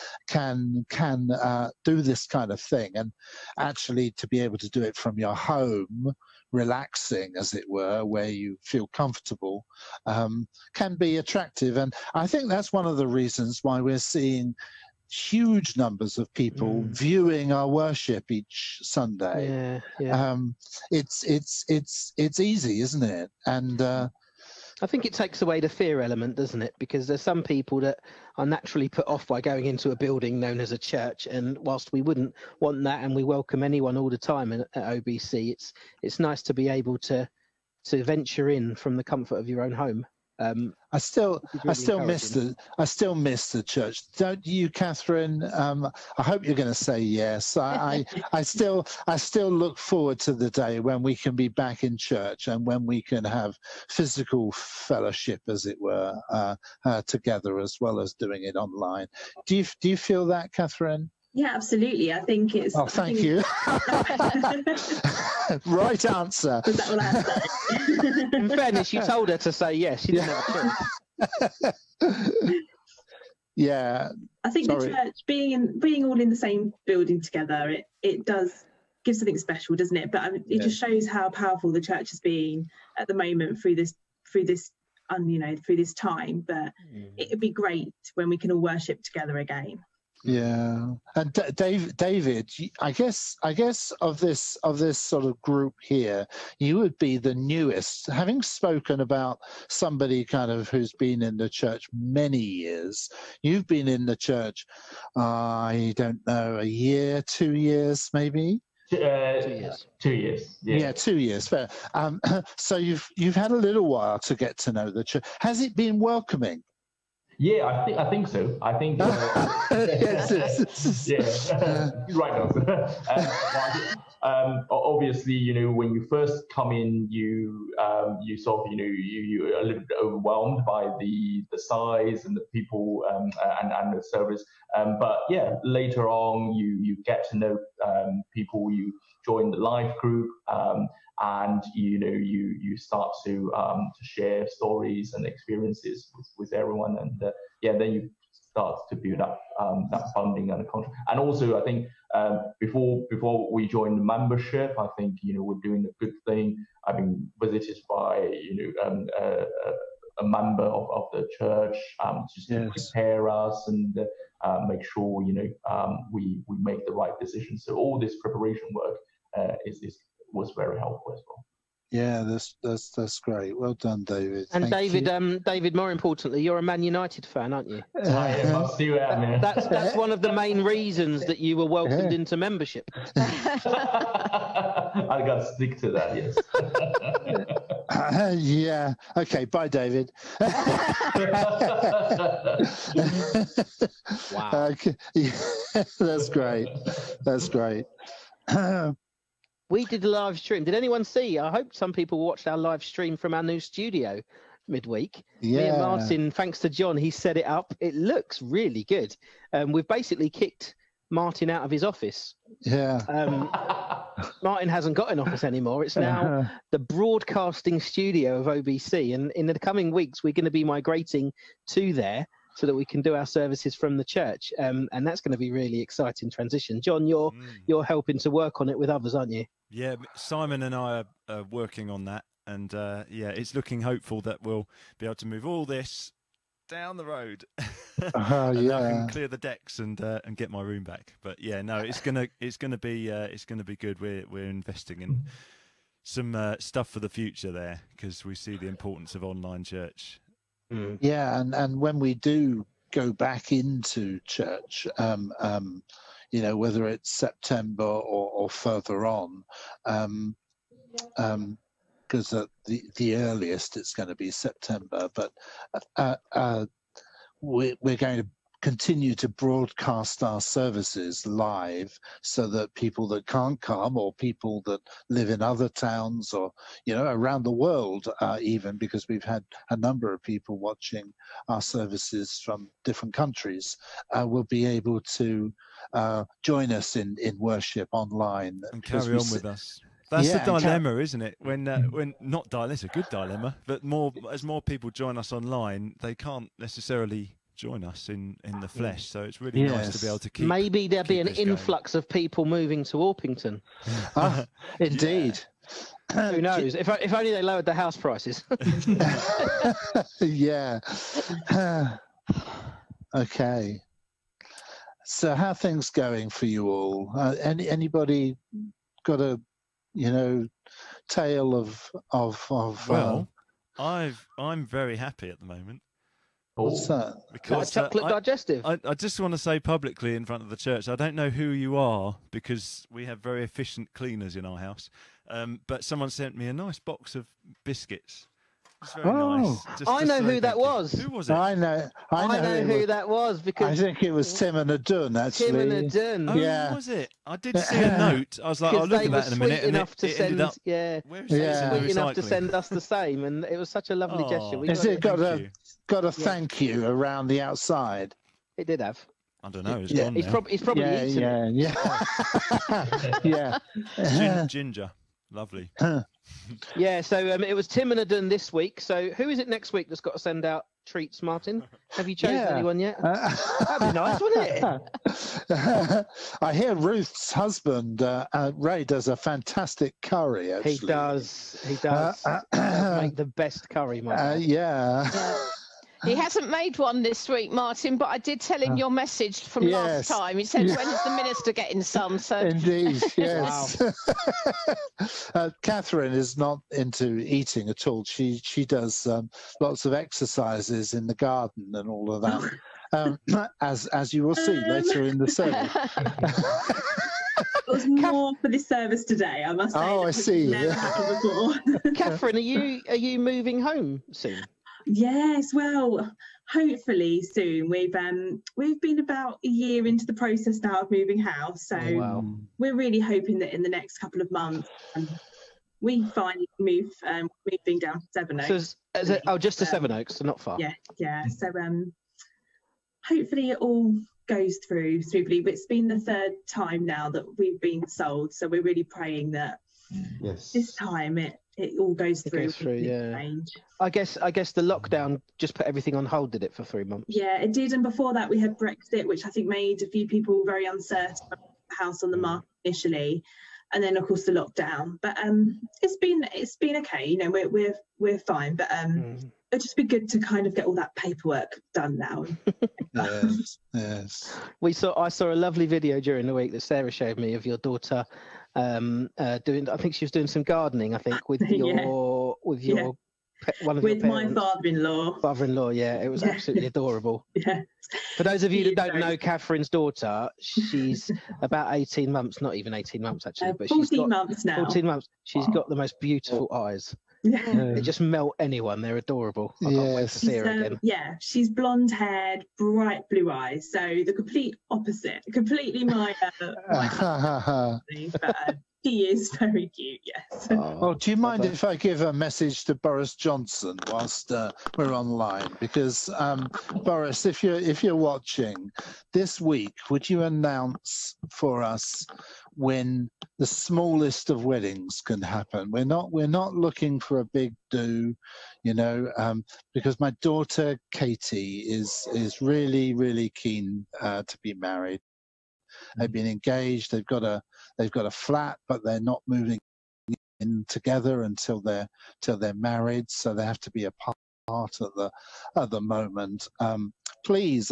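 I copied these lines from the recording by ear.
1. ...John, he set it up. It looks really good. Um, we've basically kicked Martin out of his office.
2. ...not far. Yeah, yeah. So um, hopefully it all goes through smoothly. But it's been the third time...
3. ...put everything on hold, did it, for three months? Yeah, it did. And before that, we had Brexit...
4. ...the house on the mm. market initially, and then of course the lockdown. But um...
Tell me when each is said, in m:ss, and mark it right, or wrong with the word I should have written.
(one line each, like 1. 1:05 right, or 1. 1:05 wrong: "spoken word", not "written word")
1. 3:26 right
2. 7:10 right
3. 7:25 right
4. 7:31 right.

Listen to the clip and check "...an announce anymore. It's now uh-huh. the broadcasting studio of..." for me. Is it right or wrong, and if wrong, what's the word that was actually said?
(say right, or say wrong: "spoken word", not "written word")
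wrong: "office", not "announce".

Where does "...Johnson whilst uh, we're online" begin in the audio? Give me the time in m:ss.
8:23.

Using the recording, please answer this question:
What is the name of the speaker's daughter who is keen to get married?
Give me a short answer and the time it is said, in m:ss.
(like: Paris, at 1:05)
Katie, at 8:39.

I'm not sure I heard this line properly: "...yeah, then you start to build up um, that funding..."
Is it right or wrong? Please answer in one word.
right.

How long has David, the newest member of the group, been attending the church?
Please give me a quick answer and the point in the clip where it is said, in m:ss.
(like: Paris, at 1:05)
2 years, at 1:48.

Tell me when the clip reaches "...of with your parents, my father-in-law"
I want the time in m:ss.
7:53.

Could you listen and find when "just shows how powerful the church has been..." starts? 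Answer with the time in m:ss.
1:20.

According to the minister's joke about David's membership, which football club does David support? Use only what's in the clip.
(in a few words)
Man United.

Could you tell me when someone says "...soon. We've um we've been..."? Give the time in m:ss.
6:57.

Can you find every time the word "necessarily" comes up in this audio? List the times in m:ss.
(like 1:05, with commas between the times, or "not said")
4:56.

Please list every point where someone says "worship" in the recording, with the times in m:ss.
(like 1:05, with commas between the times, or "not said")
0:17, 1:28, 4:47.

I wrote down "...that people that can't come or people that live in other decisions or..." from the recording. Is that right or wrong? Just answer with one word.
wrong.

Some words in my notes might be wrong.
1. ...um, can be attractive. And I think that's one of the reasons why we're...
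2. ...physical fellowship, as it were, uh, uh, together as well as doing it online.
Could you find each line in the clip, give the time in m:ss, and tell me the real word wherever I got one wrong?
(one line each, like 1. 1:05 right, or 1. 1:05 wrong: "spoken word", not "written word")
1. 0:10 right
2. 0:53 right.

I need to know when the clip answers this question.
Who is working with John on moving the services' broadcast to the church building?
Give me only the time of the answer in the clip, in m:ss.
3:50.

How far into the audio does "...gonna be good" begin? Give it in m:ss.
4:03.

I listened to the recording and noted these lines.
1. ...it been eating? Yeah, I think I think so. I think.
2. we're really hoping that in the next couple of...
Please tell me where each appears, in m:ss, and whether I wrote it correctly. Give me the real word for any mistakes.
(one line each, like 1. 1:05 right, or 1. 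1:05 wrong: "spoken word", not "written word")
1. 1:55 wrong: "welcoming", not "eating"
2. 7:02 right.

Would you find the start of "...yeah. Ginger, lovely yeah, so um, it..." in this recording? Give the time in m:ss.
6:04.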